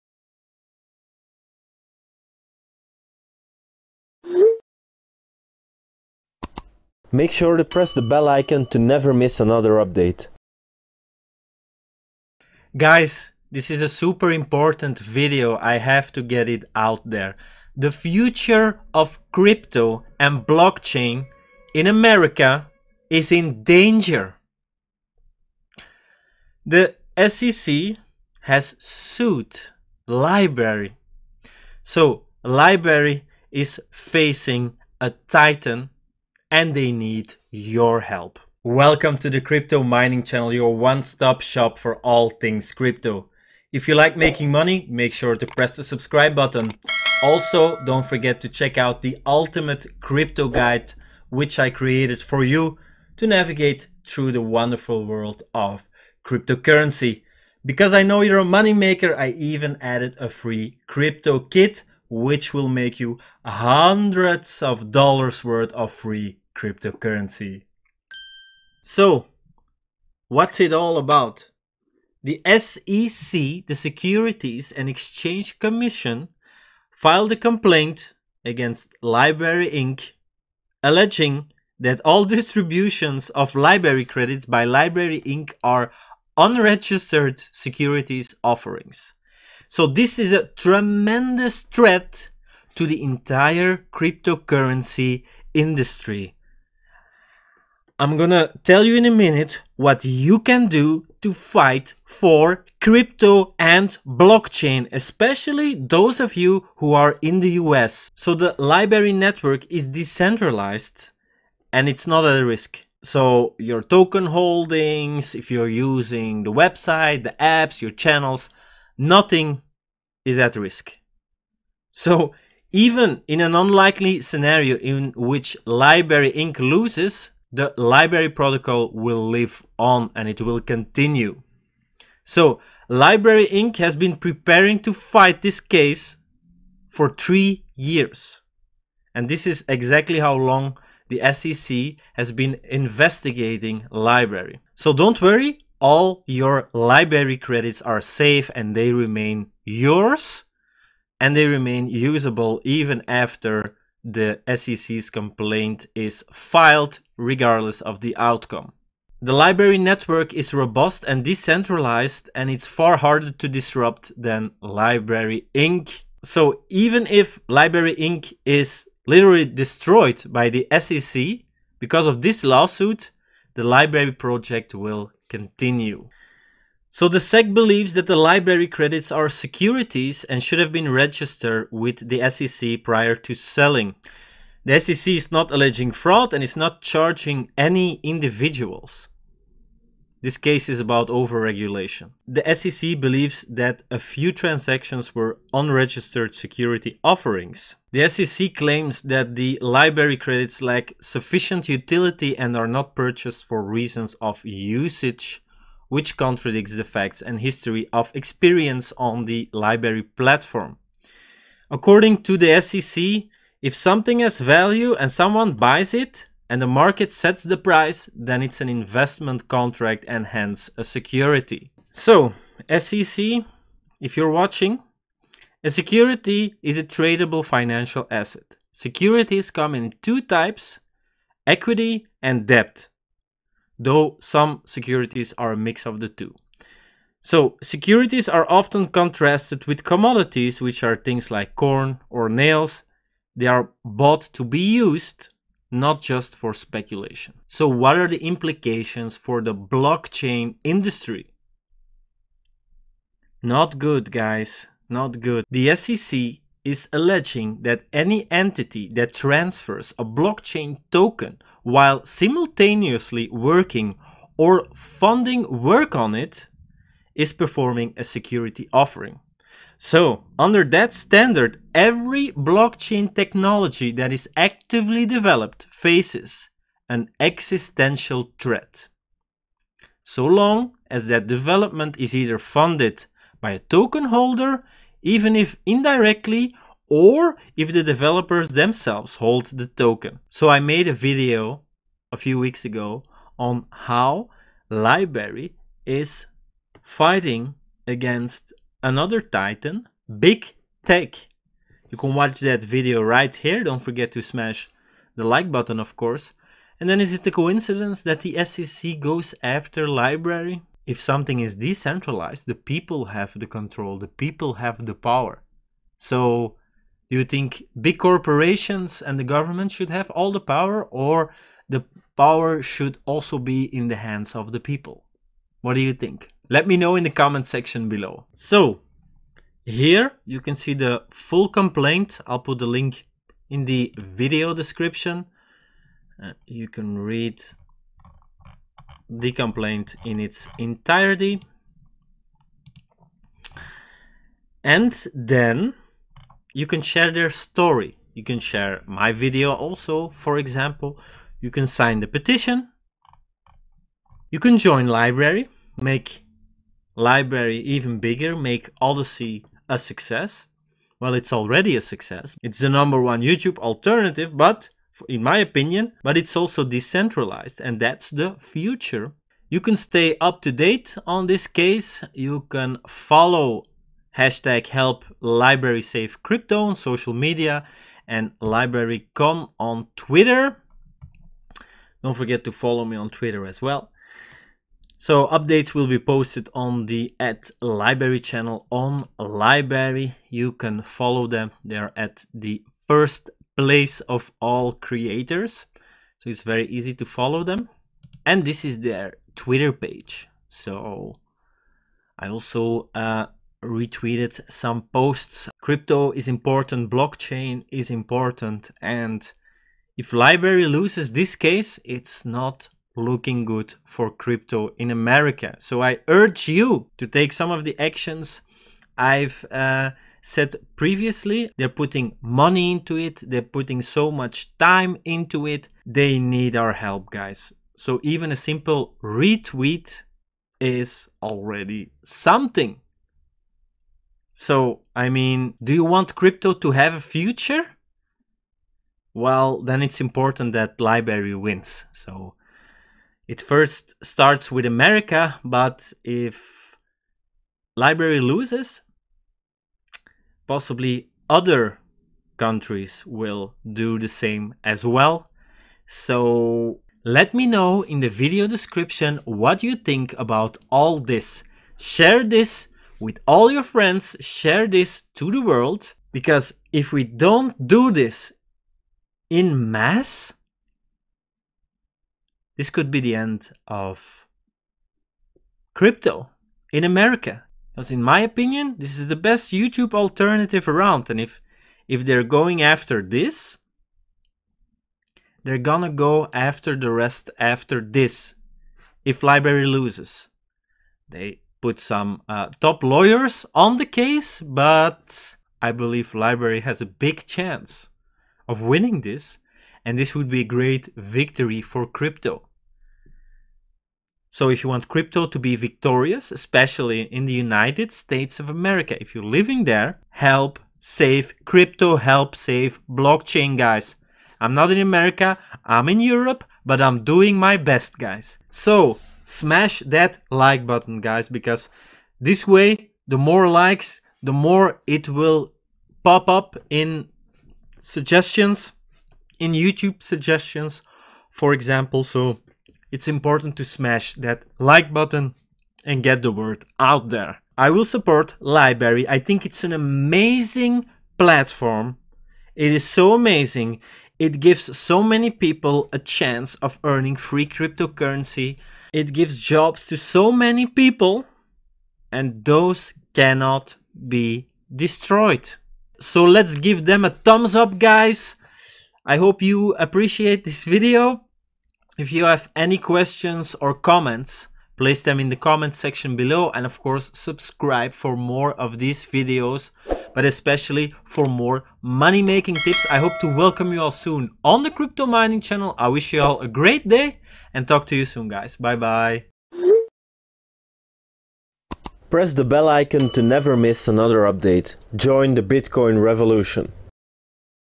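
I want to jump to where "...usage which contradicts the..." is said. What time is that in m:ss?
3:24.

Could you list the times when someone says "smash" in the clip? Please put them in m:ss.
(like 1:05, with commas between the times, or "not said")
5:04, 8:39, 8:53.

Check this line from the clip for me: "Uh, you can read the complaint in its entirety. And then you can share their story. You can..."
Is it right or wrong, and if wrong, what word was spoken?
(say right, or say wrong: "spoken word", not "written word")
right.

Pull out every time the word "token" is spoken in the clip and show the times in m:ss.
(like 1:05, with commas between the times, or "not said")
1:53, 4:20, 4:43, 4:49.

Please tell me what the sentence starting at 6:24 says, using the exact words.
So updates will be posted on the at LBRY channel on LBRY.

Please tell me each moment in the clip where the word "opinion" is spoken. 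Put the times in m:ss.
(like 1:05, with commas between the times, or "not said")
6:05, 7:58.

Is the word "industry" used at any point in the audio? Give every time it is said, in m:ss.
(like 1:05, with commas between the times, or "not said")
1:35, 4:10.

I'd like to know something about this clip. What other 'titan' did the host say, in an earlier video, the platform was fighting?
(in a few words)
Big Tech.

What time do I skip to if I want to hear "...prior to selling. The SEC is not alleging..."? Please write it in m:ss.
3:02.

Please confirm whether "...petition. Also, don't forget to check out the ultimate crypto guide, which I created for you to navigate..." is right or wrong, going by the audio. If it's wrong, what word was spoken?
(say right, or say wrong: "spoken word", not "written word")
wrong: "button", not "petition".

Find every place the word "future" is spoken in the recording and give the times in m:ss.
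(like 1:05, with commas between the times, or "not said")
0:17, 6:08, 7:17.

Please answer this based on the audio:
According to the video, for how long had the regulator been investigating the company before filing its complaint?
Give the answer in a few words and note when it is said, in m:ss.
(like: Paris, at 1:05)
3 years, at 2:17.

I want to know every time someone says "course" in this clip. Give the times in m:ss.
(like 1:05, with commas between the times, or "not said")
5:05, 9:26.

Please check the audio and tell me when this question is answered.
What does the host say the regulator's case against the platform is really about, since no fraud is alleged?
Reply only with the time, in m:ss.
3:11.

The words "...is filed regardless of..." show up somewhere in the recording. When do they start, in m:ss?
2:35.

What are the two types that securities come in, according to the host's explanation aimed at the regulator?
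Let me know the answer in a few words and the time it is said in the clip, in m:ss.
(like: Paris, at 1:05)
equity and debt, at 3:51.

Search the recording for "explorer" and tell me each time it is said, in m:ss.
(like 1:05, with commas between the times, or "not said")
not said.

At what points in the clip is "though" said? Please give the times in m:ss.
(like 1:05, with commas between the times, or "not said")
3:53.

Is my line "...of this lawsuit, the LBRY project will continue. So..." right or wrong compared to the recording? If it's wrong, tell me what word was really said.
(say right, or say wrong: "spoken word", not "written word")
right.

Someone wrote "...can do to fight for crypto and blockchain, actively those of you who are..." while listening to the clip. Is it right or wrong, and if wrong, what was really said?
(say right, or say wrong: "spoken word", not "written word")
wrong: "especially", not "actively".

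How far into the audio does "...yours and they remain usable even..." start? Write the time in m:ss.
2:29.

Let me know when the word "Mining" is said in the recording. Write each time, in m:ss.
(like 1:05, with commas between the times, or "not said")
0:39, 9:35.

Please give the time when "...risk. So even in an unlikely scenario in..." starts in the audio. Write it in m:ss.
2:00.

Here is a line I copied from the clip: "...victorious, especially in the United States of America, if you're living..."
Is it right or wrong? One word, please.
right.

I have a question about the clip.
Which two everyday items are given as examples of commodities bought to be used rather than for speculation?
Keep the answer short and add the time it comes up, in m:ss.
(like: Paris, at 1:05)
corn or nails, at 4:01.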